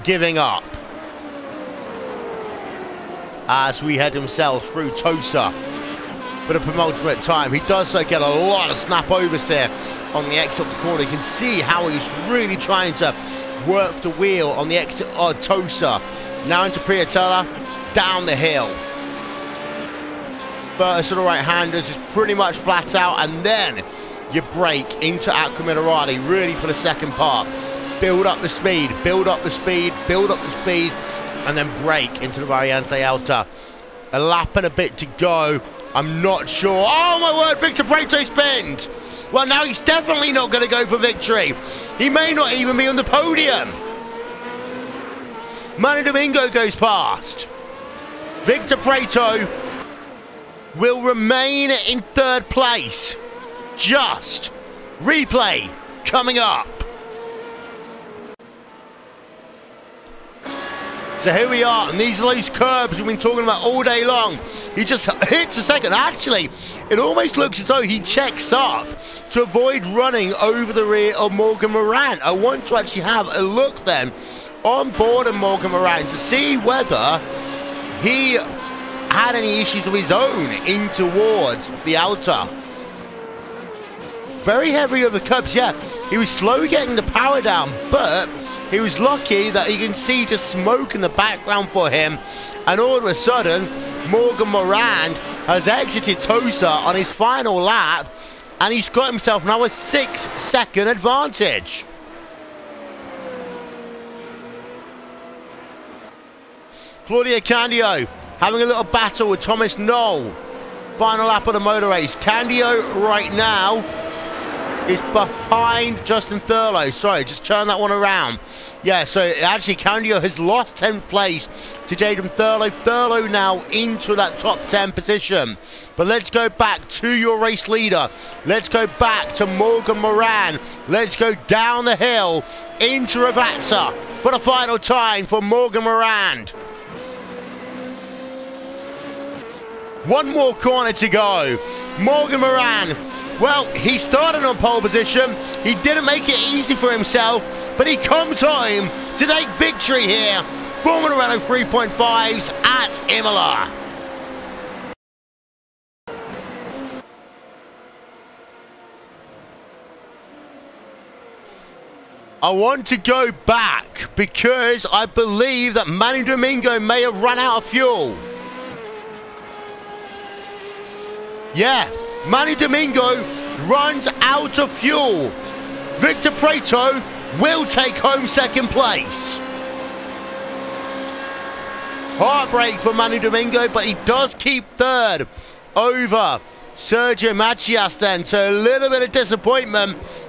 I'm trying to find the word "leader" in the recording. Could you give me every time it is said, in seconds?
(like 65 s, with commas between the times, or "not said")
127 s.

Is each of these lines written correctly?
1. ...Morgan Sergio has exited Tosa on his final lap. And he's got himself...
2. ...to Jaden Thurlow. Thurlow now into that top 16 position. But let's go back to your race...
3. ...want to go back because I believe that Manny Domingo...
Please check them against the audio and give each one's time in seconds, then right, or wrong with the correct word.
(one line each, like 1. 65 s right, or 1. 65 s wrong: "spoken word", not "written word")
1. 94 s wrong: "Morand", not "Sergio"
2. 121 s wrong: "10", not "16"
3. 162 s right.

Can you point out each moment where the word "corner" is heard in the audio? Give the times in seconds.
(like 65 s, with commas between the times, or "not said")
10 s, 140 s.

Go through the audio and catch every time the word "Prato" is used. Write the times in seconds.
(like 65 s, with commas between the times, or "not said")
37 s, 48 s, 176 s.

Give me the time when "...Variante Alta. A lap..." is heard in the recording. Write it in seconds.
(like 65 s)
32 s.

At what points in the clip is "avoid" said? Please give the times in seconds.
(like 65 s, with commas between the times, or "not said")
69 s.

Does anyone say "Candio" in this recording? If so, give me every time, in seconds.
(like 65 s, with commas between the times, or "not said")
107 s, 112 s, 119 s.